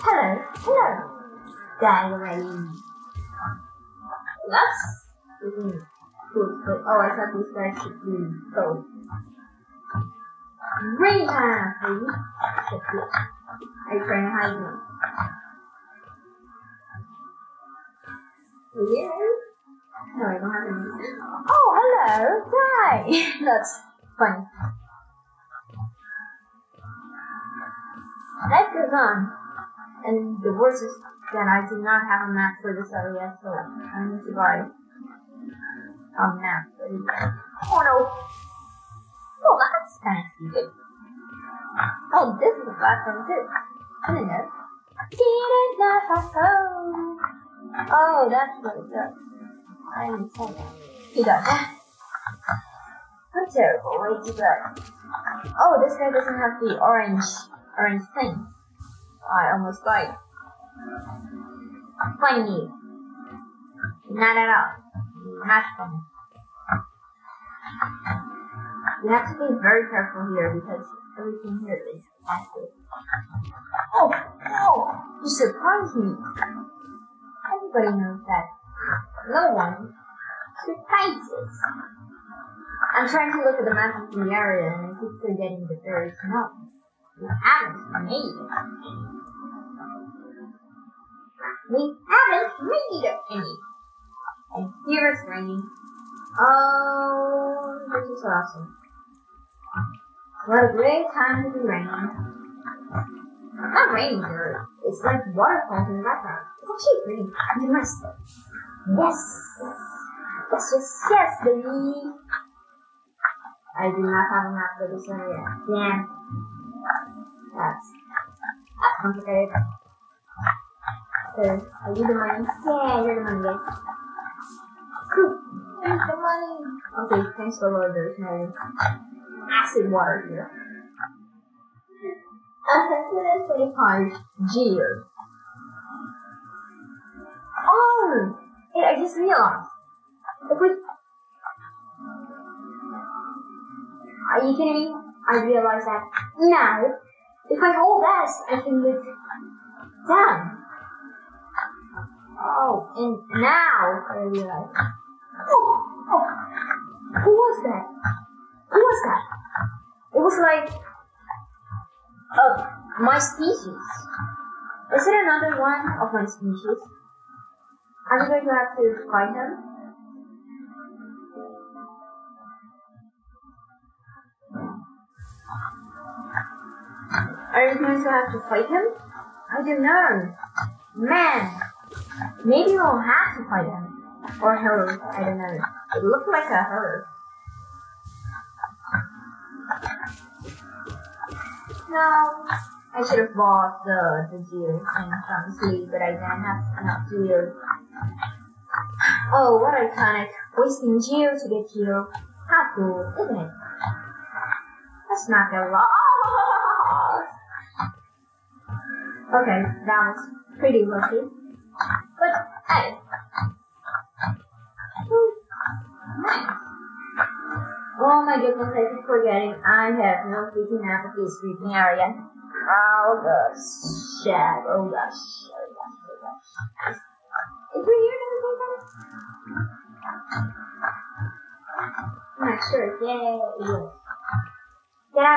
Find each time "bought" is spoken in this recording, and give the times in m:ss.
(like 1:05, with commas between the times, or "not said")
3:13.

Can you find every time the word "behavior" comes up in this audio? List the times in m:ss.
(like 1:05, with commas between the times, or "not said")
not said.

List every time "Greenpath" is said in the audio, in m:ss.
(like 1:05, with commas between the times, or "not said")
0:10.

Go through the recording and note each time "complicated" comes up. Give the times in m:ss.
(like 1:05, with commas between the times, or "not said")
1:58.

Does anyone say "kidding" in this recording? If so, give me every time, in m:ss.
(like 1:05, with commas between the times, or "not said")
2:24.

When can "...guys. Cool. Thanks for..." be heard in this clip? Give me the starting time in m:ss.
2:03.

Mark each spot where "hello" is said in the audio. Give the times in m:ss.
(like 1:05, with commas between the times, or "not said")
0:00, 0:21.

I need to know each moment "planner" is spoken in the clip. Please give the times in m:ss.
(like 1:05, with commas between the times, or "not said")
not said.